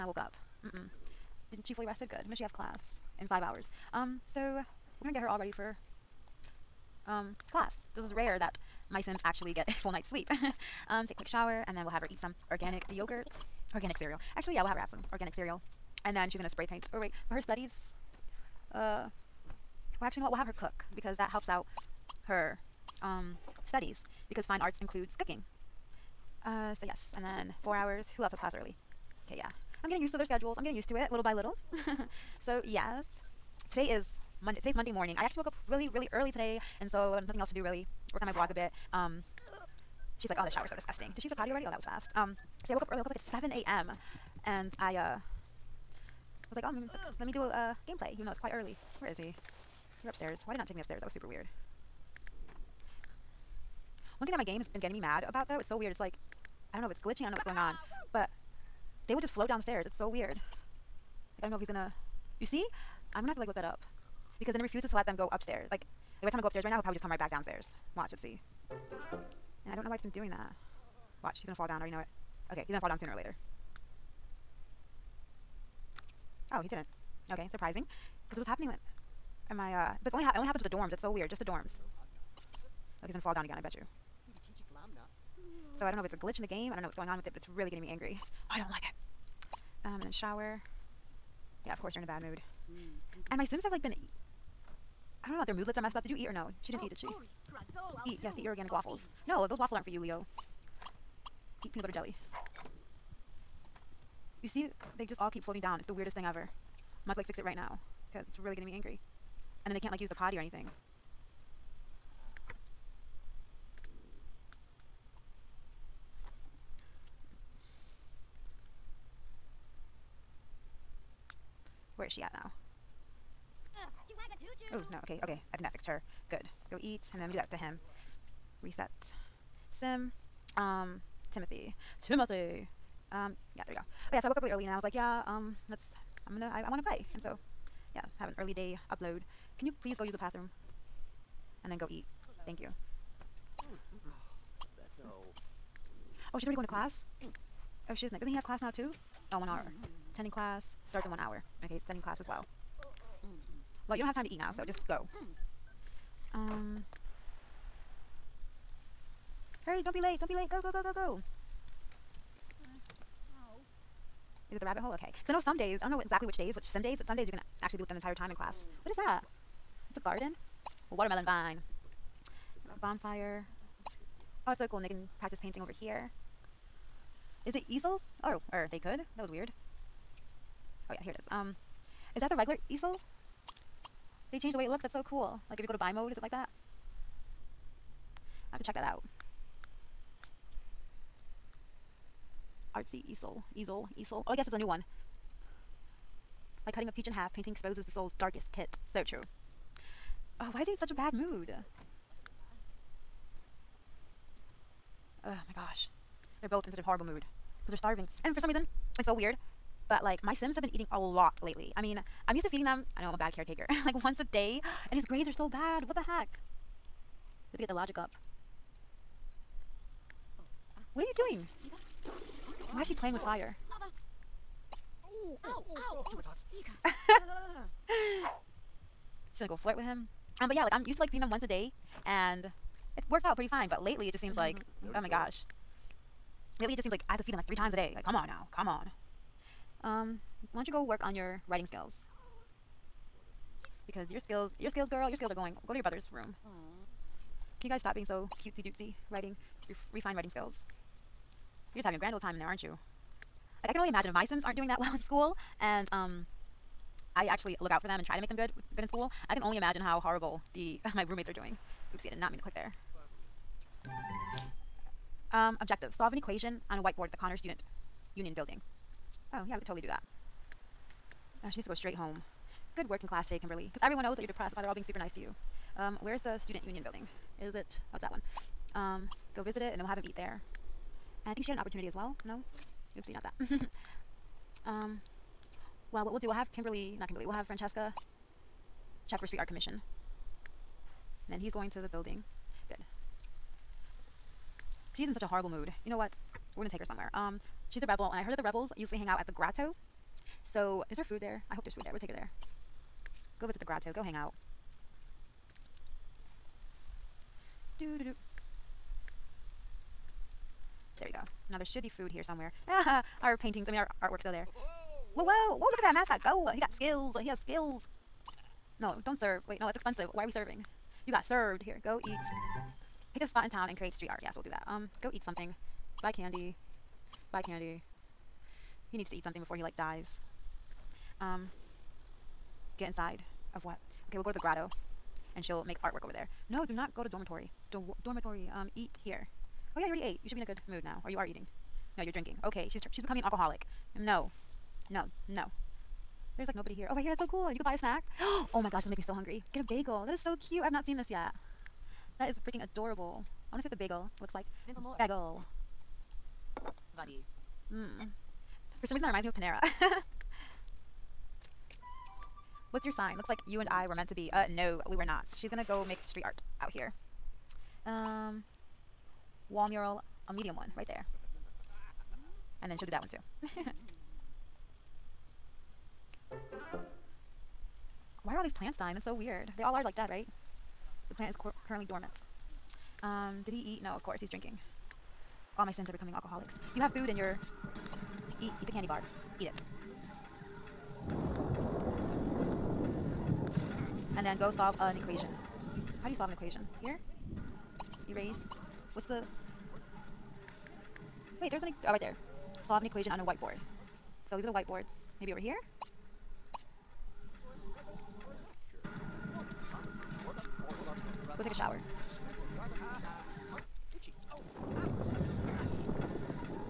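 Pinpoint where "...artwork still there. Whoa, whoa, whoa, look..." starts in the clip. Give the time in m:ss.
5:14.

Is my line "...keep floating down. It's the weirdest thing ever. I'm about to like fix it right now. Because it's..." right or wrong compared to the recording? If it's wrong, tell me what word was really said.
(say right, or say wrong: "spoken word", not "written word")
right.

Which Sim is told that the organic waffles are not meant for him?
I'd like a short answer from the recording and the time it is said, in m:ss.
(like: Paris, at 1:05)
Leo, at 1:39.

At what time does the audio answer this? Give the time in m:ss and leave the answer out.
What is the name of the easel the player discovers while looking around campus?
3:12.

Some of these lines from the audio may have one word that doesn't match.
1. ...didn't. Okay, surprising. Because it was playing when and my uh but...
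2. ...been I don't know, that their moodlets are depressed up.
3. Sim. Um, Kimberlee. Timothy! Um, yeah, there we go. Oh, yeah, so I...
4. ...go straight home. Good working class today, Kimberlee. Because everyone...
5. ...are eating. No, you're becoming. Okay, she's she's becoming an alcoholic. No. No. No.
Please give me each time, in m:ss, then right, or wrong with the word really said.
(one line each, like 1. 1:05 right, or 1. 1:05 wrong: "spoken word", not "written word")
1. 1:16 wrong: "happening", not "playing"
2. 1:33 wrong: "messed", not "depressed"
3. 2:09 wrong: "Timothy", not "Kimberlee"
4. 4:31 right
5. 5:41 wrong: "drinking", not "becoming".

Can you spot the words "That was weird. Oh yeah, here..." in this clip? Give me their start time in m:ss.
2:59.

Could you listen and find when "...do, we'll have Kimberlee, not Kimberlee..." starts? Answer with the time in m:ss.
4:46.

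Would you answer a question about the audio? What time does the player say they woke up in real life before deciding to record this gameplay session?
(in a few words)
7 a.m.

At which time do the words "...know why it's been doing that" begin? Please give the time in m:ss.
1:09.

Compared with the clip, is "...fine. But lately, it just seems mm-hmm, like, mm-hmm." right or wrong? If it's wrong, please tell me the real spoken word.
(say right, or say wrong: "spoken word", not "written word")
right.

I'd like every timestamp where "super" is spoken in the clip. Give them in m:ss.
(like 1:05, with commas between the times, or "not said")
0:51, 4:34.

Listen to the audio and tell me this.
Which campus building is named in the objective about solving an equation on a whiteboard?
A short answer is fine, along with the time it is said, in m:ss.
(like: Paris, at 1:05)
Connor Student Union, at 4:27.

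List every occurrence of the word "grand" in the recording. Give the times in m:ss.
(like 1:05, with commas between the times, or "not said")
4:11.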